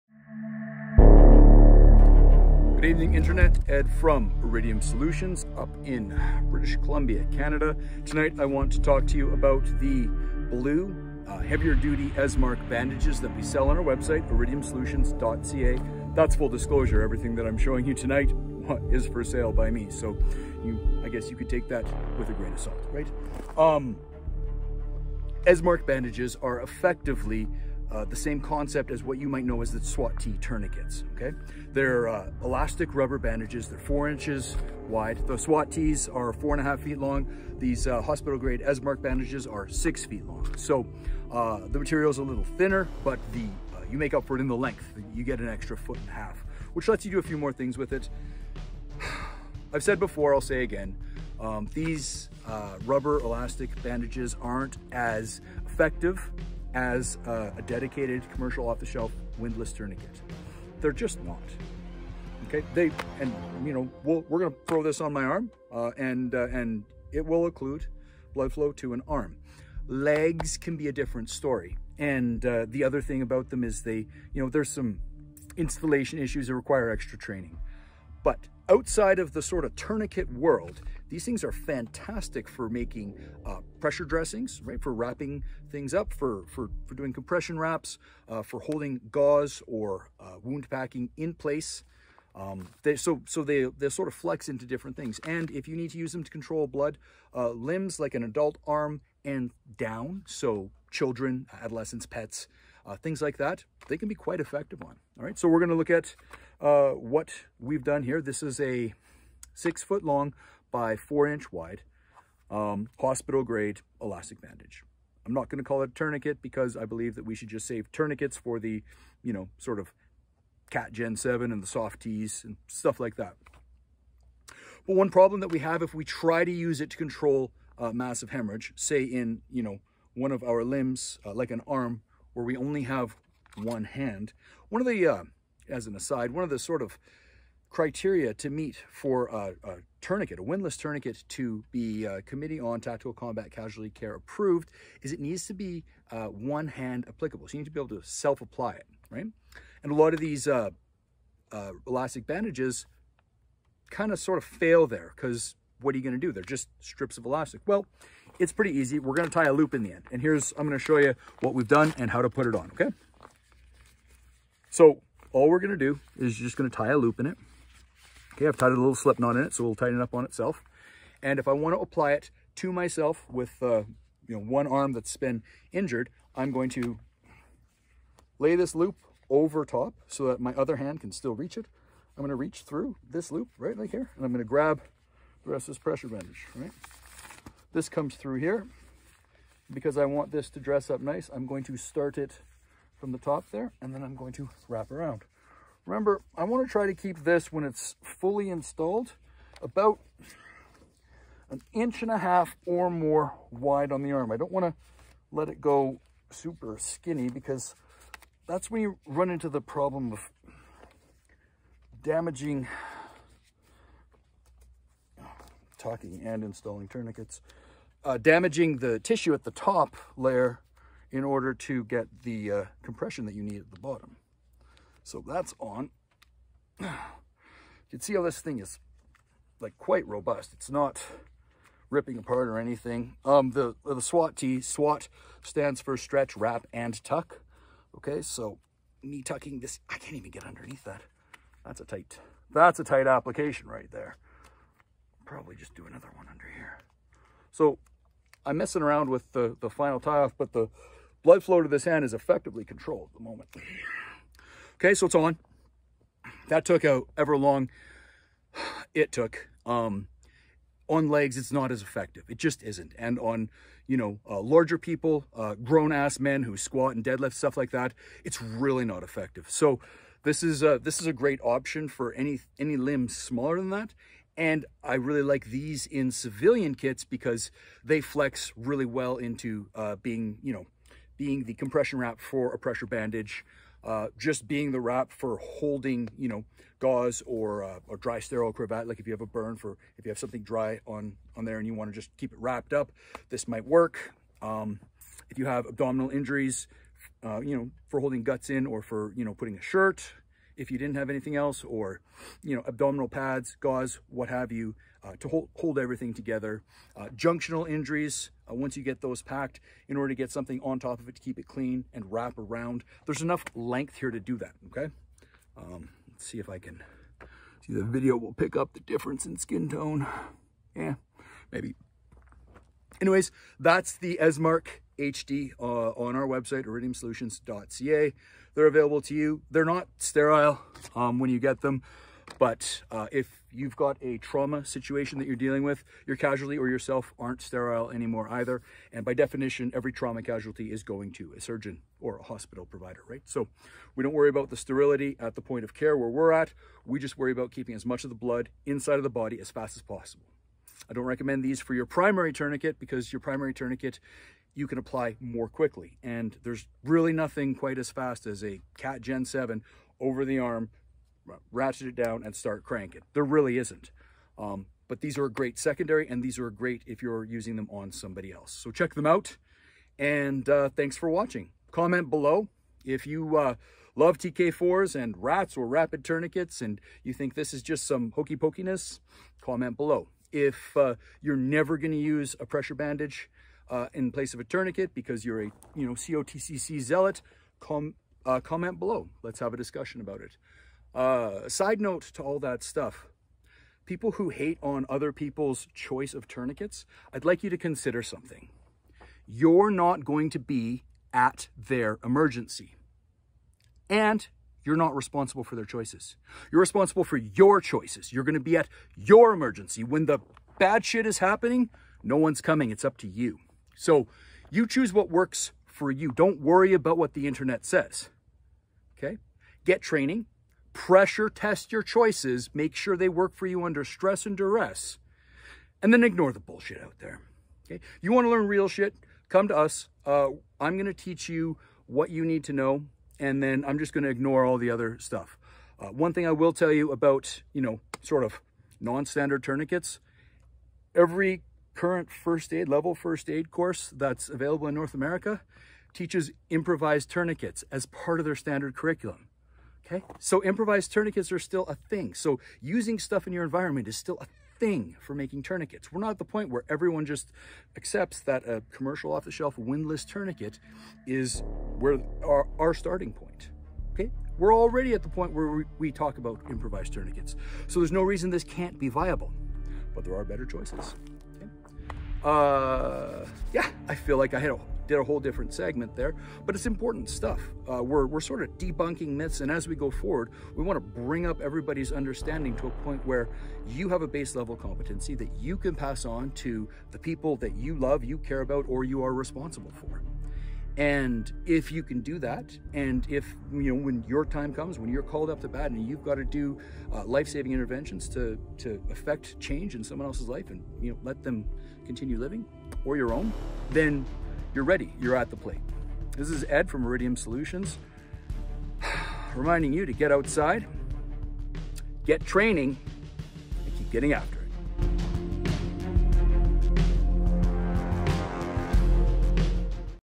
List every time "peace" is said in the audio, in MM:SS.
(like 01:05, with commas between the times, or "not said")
not said.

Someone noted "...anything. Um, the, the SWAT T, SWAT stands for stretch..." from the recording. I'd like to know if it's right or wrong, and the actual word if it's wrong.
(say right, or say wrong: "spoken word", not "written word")
right.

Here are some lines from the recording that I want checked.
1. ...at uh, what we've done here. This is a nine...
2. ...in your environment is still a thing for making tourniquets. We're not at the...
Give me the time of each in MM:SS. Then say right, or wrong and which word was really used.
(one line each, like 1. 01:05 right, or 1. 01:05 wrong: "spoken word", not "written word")
1. 01:45 wrong: "six", not "nine"
2. 07:33 right.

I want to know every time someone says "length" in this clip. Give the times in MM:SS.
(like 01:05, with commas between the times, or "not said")
00:44, 05:13.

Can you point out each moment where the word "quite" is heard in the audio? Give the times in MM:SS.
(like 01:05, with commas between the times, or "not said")
01:44, 03:49, 05:57.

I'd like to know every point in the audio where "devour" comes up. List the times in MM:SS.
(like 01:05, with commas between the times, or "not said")
not said.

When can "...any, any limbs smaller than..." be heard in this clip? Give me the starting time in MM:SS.
04:32.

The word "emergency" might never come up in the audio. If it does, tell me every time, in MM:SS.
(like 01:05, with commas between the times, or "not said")
06:42, 06:49.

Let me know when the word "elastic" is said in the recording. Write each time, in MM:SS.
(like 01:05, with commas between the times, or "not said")
00:32, 00:53, 01:54, 02:31, 02:37.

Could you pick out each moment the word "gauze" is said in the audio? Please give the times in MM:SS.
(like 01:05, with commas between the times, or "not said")
01:29, 04:46, 05:03.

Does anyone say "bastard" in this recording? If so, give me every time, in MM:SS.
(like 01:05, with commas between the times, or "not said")
not said.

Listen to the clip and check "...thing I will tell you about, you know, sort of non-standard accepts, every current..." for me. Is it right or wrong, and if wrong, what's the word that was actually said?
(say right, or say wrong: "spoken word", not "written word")
wrong: "tourniquets", not "accepts".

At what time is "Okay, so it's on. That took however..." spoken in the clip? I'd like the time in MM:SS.
04:14.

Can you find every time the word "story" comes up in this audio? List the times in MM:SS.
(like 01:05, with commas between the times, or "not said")
01:11.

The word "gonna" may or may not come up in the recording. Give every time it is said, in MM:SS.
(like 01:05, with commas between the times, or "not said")
01:04, 01:45.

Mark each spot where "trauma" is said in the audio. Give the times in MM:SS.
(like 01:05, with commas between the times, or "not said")
05:34, 05:39.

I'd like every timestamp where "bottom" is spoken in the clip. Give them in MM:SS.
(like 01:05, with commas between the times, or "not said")
03:43.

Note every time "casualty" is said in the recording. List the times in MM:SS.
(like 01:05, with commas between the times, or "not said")
02:23, 05:36, 05:40.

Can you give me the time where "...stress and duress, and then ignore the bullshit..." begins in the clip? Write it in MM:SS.
07:03.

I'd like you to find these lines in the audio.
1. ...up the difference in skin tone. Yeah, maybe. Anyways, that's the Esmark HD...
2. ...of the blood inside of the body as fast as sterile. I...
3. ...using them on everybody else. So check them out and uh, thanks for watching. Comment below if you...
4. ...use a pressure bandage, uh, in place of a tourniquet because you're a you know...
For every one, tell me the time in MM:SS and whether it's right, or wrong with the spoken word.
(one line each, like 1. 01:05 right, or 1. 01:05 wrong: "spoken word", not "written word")
1. 05:18 right
2. 05:48 wrong: "possible", not "sterile"
3. 06:07 wrong: "somebody", not "everybody"
4. 06:21 right.